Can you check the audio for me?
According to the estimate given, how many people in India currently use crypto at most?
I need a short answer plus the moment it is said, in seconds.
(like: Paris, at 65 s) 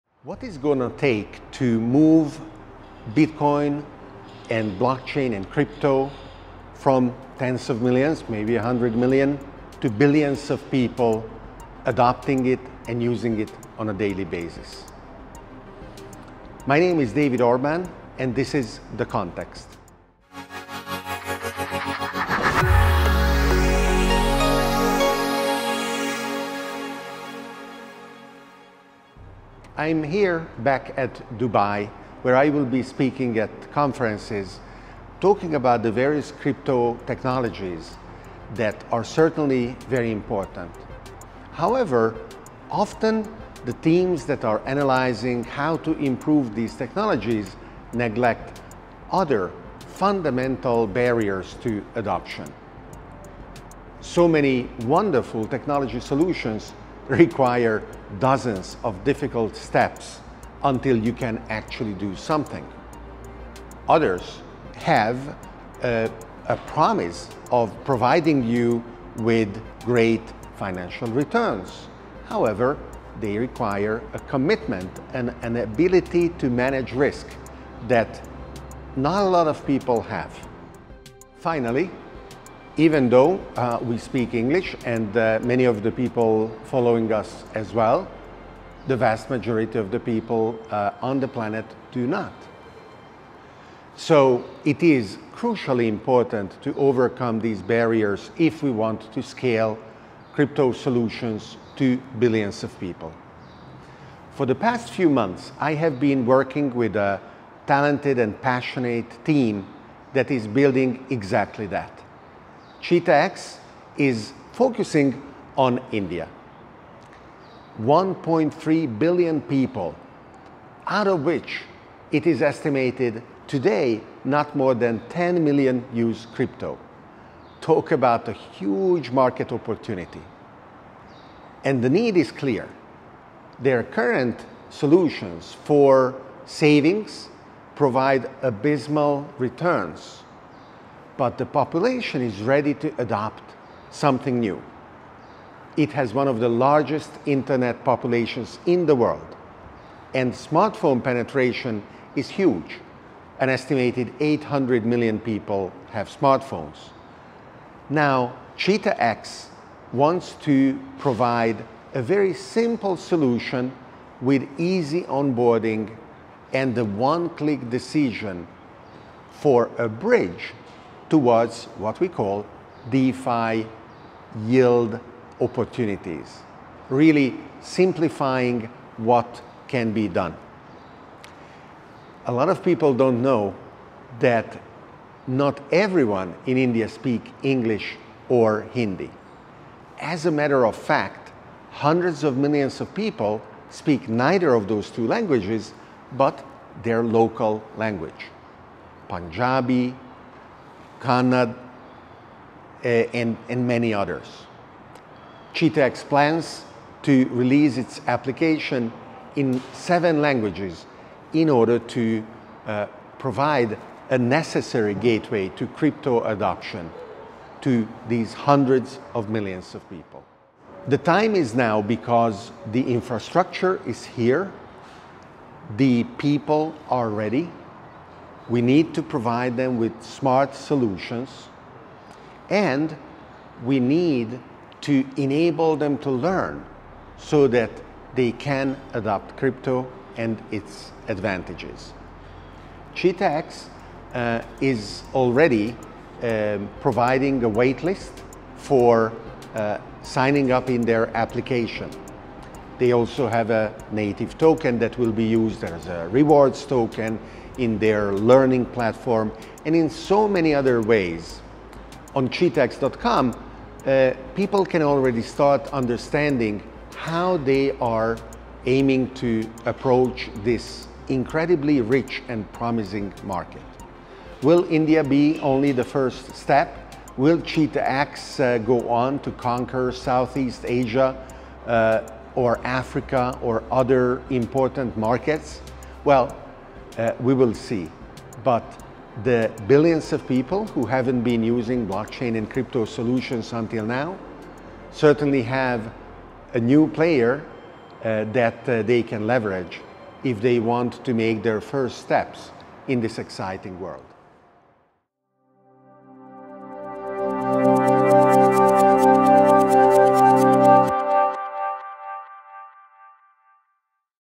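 10 million, at 125 s.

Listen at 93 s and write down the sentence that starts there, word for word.
So it is crucially important to overcome these barriers if we want to scale crypto solutions to billions of people.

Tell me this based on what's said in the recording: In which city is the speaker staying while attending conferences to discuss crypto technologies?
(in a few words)
Dubai.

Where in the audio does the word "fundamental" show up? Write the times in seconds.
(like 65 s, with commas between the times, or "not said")
49 s.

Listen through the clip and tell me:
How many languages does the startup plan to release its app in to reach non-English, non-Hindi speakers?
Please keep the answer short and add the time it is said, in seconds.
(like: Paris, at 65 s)
7, at 209 s.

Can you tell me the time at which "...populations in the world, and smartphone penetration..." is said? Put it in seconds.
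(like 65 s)
147 s.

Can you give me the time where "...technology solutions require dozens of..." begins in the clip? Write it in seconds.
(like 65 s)
55 s.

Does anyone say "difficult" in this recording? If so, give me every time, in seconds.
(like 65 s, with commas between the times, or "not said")
59 s.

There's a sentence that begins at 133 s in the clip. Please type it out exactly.
Their current solutions for savings provide abysmal returns but the population is ready to adopt something new.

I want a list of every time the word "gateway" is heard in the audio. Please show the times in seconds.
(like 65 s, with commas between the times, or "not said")
214 s.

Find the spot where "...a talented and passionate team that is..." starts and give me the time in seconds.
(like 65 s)
106 s.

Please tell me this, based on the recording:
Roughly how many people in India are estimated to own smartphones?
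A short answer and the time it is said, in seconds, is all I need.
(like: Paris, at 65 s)
800 million, at 154 s.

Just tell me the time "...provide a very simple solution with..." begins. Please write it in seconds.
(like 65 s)
160 s.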